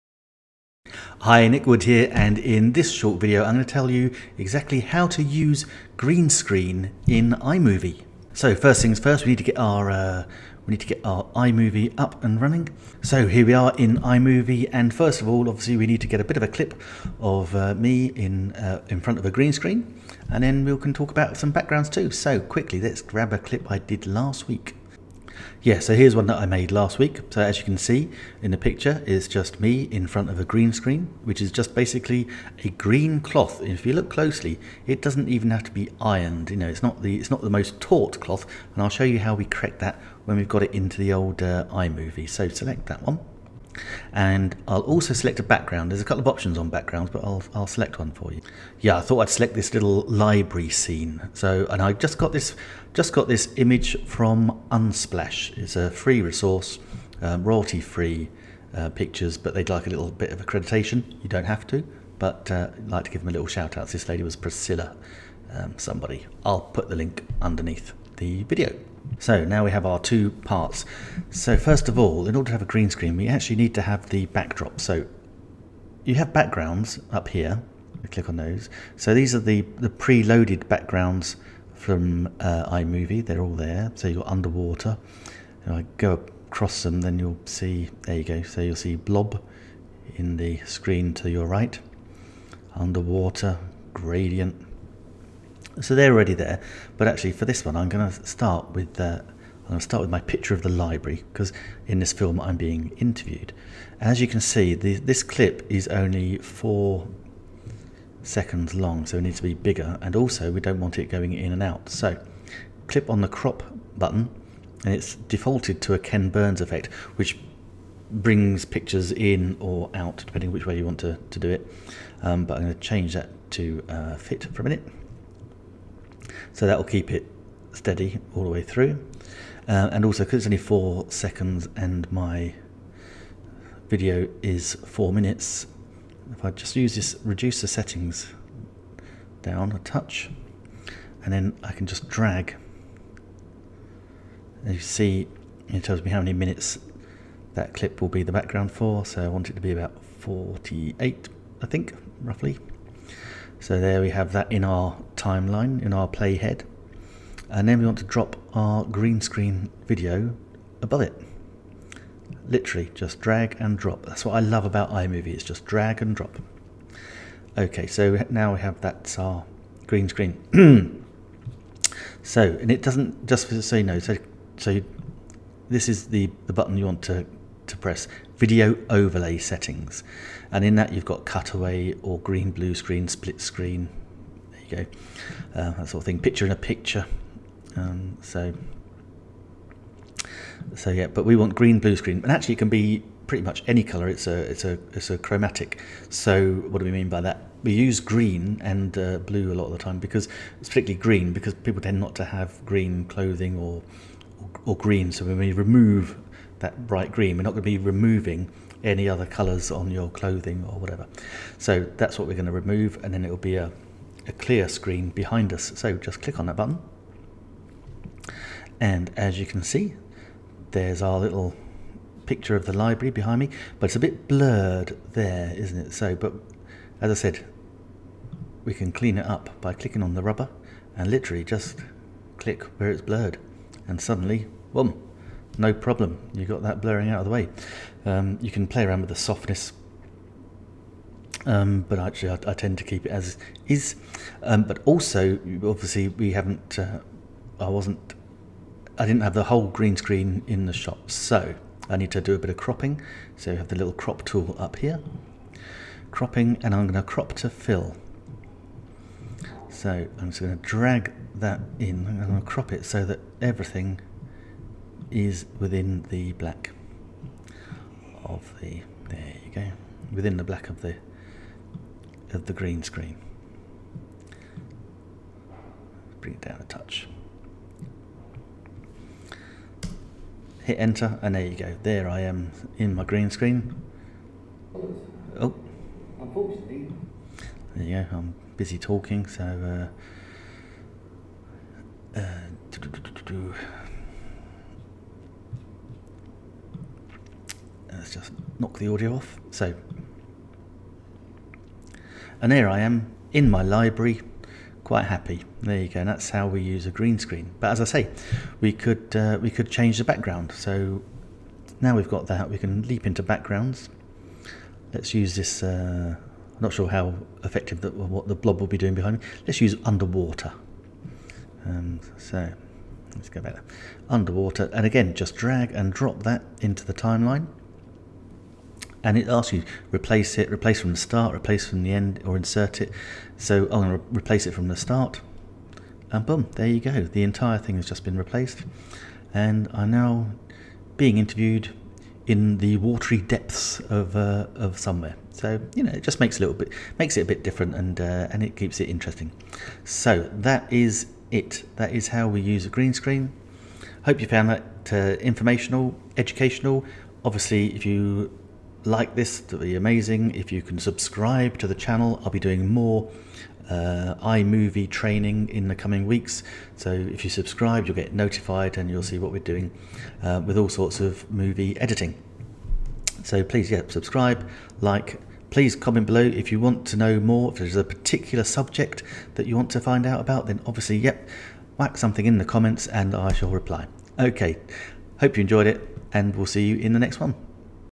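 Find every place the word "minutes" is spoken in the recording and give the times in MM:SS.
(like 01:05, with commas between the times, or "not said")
02:04, 02:15, 02:26.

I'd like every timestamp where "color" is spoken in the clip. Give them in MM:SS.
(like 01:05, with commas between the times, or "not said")
03:13, 03:29.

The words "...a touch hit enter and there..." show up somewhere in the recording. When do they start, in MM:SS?
04:36.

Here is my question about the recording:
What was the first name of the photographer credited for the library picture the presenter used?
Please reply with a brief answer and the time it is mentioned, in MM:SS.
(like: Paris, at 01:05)
Priscilla, at 01:04.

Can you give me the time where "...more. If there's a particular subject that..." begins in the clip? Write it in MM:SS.
06:17.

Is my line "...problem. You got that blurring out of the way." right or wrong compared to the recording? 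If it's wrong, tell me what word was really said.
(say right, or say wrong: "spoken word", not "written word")
right.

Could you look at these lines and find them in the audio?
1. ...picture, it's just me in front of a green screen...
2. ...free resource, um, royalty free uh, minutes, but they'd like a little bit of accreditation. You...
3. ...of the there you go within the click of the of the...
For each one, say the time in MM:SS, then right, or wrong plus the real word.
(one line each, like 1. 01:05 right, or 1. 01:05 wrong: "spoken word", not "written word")
1. 00:28 right
2. 00:55 wrong: "pictures", not "minutes"
3. 04:28 wrong: "black", not "click".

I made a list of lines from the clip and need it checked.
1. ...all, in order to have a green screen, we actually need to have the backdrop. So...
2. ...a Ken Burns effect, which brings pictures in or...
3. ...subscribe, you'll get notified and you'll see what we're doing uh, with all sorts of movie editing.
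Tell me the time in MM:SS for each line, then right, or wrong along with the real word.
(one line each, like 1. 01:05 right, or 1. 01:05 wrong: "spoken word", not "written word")
1. 01:11 right
2. 01:55 right
3. 06:07 right.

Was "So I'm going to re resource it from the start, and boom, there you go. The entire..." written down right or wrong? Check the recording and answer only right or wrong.
wrong.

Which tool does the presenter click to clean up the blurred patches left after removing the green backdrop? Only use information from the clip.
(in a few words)
rubber.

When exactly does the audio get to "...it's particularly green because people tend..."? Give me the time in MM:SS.
03:20.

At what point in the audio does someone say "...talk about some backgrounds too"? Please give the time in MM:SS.
00:20.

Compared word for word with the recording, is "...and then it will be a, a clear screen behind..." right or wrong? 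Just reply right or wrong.
right.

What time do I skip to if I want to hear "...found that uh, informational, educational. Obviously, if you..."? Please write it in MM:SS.
05:54.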